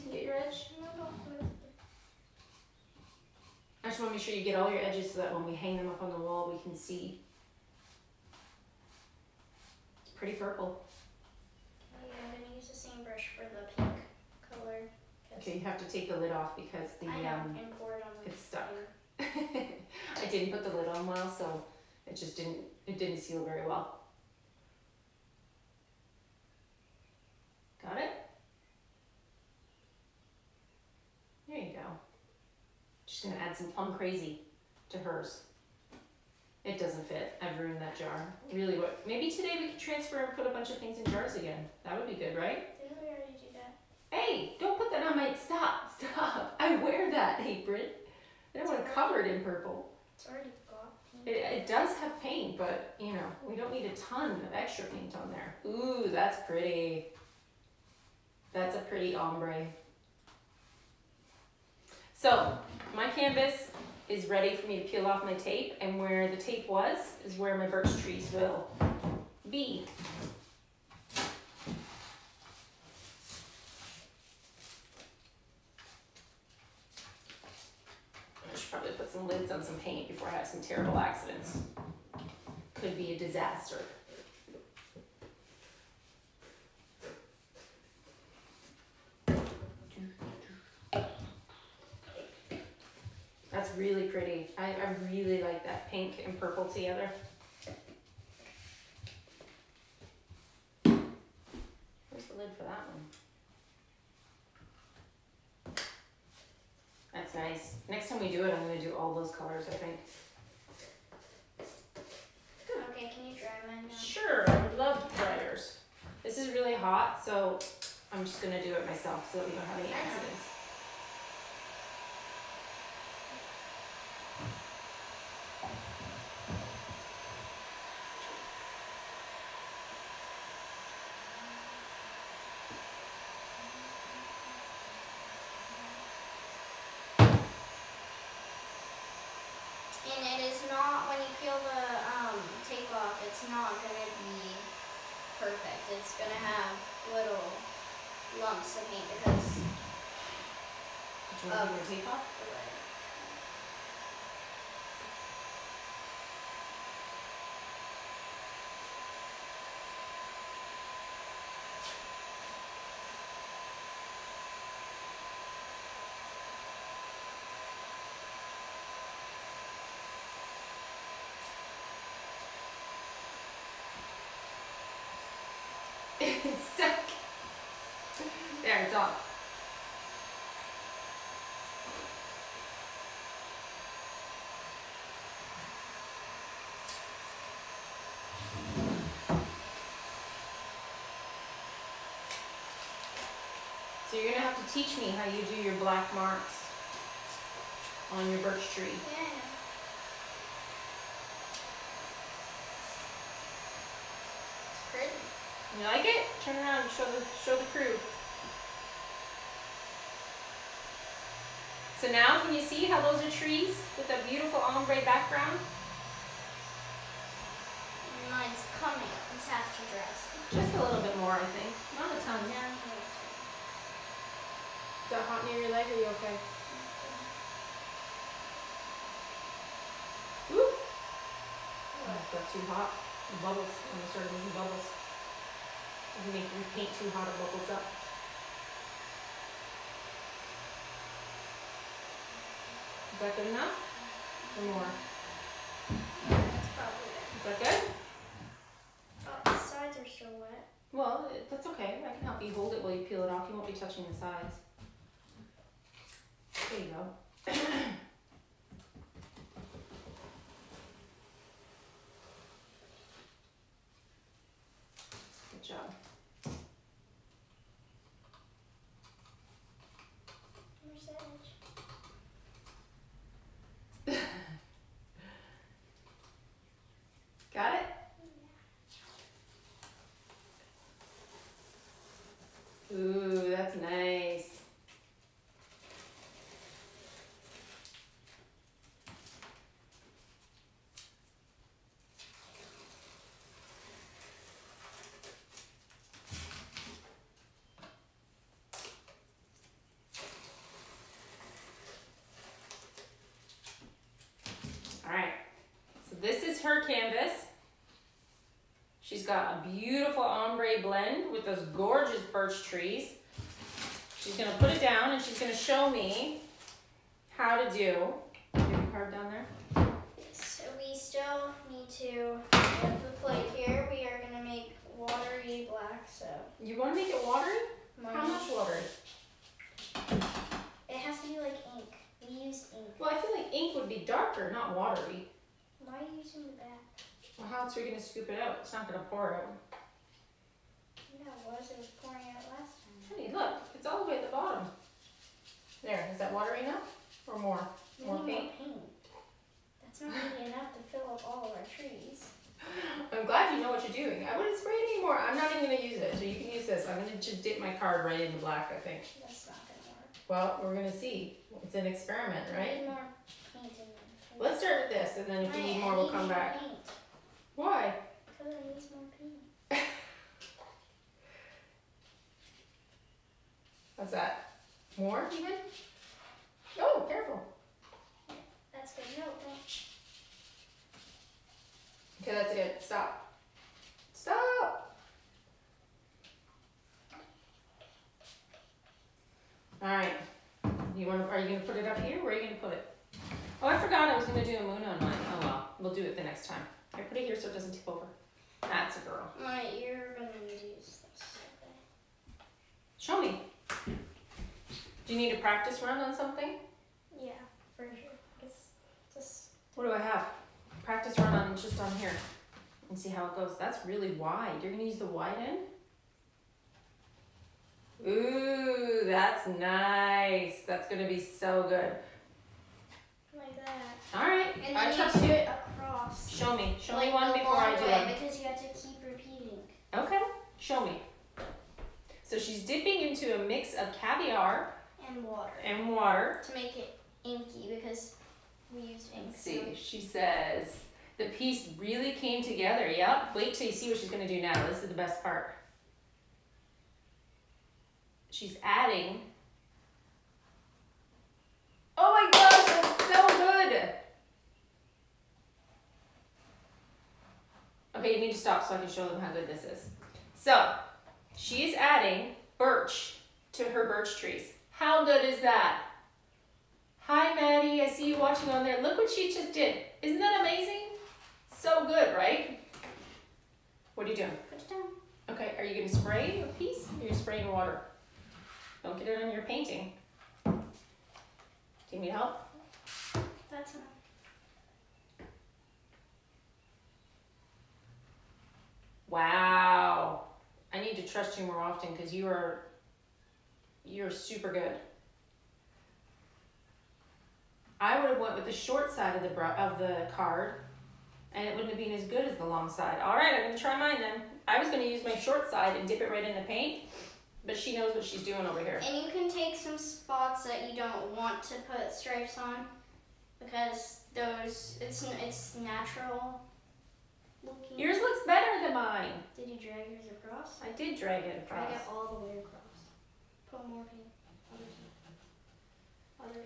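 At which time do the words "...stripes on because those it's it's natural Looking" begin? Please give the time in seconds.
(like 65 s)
511 s.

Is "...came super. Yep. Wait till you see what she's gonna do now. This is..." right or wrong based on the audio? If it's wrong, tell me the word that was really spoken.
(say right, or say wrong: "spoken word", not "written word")
wrong: "together", not "super".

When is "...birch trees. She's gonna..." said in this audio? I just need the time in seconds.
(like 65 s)
312 s.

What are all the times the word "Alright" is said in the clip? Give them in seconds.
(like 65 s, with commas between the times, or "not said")
389 s.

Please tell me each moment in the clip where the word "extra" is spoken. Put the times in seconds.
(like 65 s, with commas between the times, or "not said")
54 s.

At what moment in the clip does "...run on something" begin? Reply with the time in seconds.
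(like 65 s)
405 s.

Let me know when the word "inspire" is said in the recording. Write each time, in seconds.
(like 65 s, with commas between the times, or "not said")
not said.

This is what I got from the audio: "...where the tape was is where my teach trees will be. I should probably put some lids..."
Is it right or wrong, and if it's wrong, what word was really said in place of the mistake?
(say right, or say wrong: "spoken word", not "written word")
wrong: "birch", not "teach".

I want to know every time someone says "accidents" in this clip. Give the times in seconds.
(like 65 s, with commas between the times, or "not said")
80 s, 119 s.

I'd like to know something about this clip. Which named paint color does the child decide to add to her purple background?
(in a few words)
Plum Crazy.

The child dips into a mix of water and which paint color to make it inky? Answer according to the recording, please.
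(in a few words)
Caviar.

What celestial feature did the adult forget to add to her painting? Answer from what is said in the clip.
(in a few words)
A moon.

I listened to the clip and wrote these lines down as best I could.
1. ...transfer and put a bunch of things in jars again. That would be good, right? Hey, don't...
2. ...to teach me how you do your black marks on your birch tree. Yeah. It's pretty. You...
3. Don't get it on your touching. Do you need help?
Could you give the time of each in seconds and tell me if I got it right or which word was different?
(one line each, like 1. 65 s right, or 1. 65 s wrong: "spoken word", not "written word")
1. 39 s right
2. 194 s right
3. 478 s wrong: "painting", not "touching".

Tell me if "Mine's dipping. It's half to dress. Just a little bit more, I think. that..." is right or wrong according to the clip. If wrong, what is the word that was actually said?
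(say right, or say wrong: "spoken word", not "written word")
wrong: "coming", not "dipping".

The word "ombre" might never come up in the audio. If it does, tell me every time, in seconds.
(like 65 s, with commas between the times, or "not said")
59 s, 214 s, 310 s.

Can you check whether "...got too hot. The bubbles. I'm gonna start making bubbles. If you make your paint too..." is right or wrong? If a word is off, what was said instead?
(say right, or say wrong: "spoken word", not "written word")
right.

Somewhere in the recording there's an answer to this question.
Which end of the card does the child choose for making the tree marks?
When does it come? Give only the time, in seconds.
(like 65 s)
415 s.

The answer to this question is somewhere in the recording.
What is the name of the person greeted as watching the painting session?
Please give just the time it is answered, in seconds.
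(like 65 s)
467 s.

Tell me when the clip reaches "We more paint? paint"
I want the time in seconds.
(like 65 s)
348 s.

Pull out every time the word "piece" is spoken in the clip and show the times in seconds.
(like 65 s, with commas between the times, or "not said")
441 s, 476 s.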